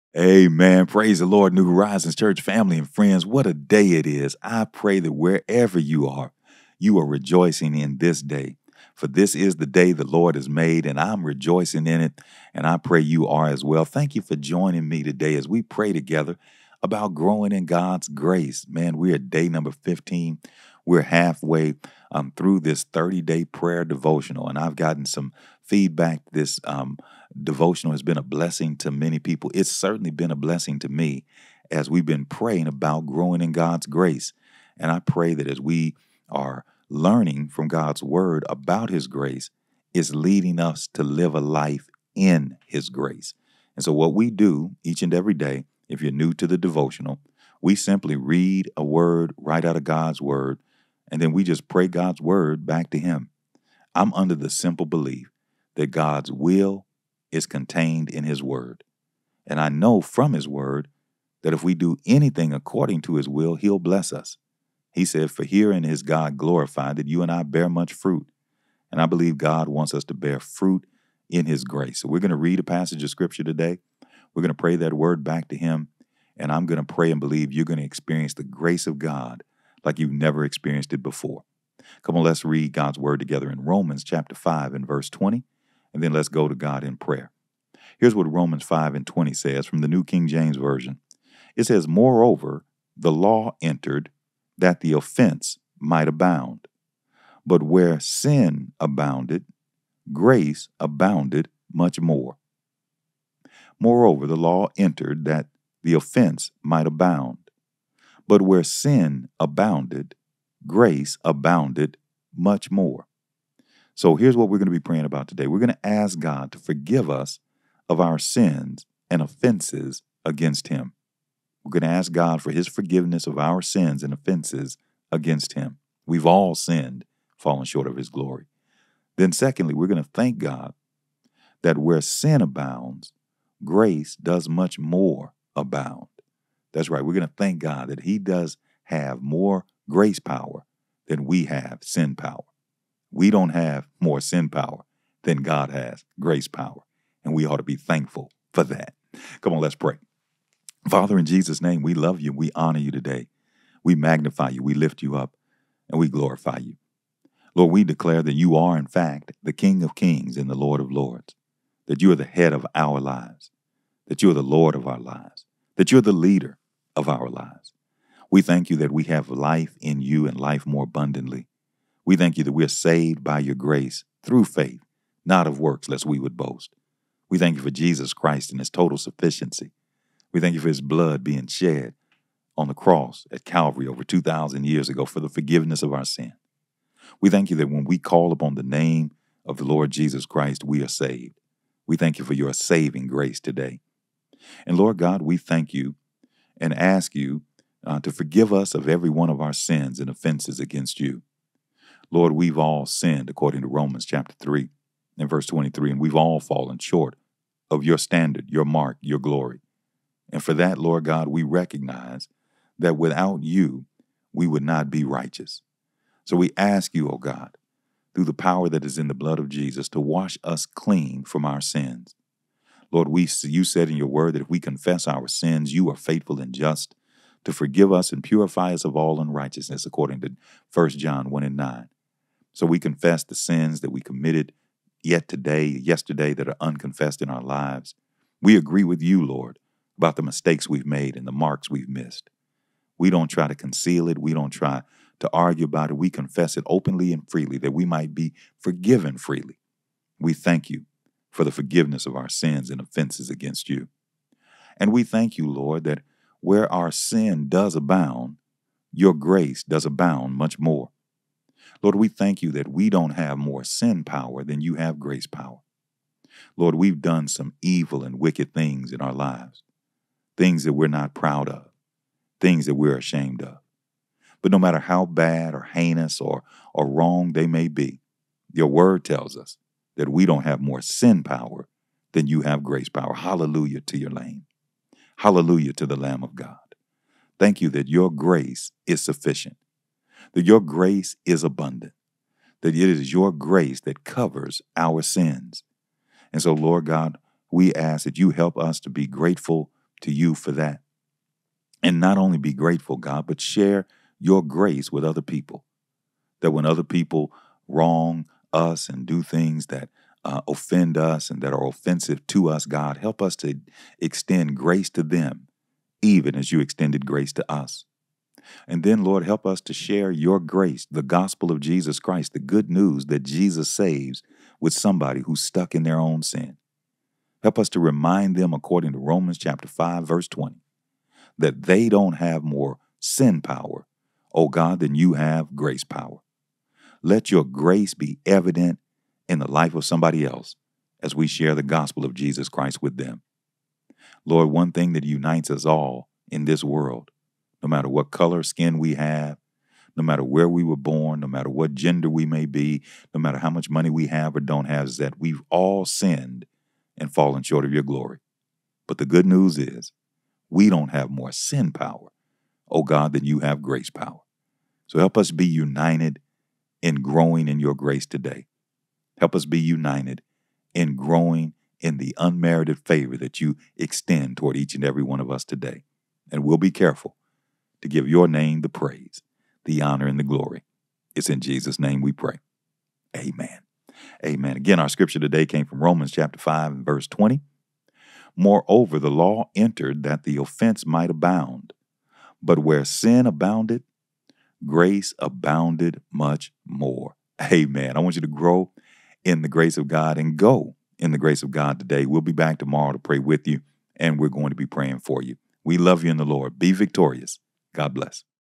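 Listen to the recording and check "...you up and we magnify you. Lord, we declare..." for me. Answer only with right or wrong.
wrong.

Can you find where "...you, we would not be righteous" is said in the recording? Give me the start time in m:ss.
3:33.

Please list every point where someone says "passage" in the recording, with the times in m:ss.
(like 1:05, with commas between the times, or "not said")
1:12.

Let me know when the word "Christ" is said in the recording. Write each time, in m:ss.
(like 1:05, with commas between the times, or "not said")
2:58, 3:10, 5:21, 5:42.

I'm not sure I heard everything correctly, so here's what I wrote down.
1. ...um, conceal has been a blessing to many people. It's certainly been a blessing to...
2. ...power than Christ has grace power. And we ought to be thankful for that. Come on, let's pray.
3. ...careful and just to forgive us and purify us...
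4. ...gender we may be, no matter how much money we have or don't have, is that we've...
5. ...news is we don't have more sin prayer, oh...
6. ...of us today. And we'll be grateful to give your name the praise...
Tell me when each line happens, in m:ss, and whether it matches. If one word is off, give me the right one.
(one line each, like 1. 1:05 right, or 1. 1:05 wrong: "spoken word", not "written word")
1. 0:26 wrong: "devotional", not "conceal"
2. 2:24 wrong: "God", not "Christ"
3. 3:45 wrong: "faithful", not "careful"
4. 5:51 right
5. 5:59 wrong: "power", not "prayer"
6. 6:15 wrong: "careful", not "grateful".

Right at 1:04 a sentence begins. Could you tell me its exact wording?
He said, For herein is God glorified that you and I bear much fruit.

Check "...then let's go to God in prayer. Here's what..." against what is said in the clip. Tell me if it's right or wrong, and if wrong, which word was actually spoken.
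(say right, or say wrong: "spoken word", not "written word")
right.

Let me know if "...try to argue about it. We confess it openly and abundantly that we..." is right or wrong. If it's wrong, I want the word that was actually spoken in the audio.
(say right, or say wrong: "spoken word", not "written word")
wrong: "freely", not "abundantly".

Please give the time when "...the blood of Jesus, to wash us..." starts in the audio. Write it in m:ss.
3:39.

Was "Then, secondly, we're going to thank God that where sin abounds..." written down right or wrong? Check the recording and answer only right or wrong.
right.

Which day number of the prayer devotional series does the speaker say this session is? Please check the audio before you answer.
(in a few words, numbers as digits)
15.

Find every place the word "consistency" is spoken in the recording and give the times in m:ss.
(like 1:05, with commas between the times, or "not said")
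not said.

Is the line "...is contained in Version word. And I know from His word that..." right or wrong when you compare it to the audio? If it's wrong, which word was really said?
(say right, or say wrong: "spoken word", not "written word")
wrong: "His", not "Version".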